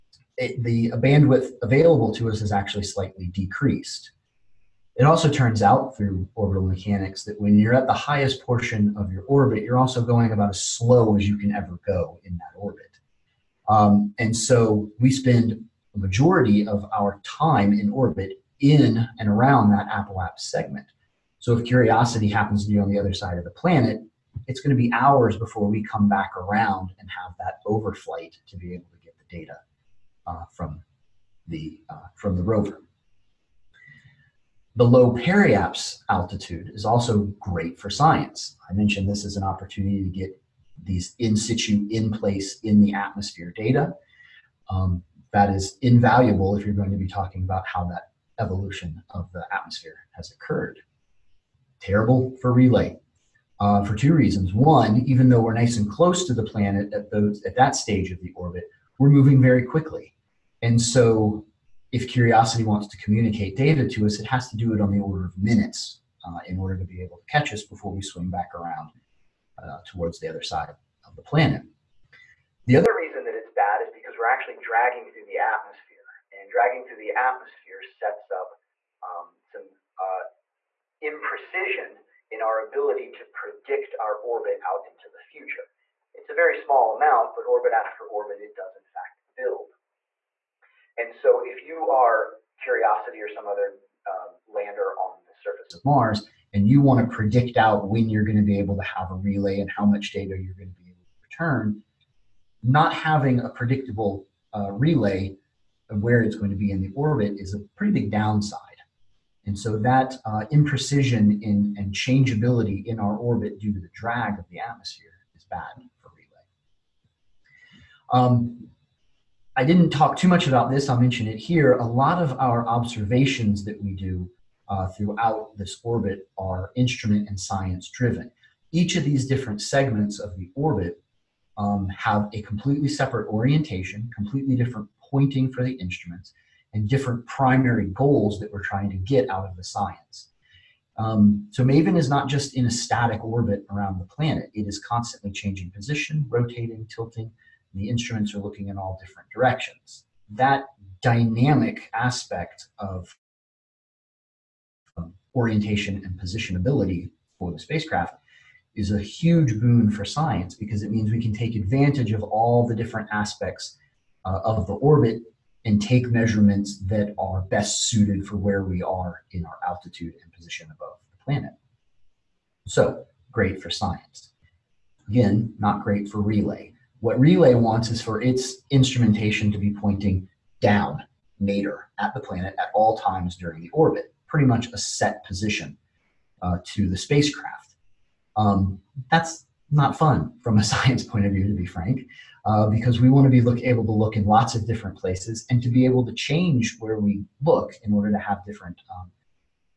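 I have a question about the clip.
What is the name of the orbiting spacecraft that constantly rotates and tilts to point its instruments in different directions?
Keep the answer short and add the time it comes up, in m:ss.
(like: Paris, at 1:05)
MAVEN, at 2:21.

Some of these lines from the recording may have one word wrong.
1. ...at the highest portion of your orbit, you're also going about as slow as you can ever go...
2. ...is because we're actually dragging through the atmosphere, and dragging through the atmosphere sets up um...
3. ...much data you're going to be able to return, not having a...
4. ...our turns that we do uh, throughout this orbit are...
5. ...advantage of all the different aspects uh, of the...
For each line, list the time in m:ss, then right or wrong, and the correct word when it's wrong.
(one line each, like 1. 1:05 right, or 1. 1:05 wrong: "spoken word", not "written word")
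1. 0:07 right
2. 1:13 right
3. 1:39 right
4. 2:02 wrong: "observations", not "turns"
5. 2:41 right.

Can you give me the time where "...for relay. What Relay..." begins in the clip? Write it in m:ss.
2:56.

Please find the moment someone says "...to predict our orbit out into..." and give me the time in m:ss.
1:23.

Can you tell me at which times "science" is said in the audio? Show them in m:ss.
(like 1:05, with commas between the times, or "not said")
0:37, 2:07, 2:19, 2:40, 2:53, 3:10.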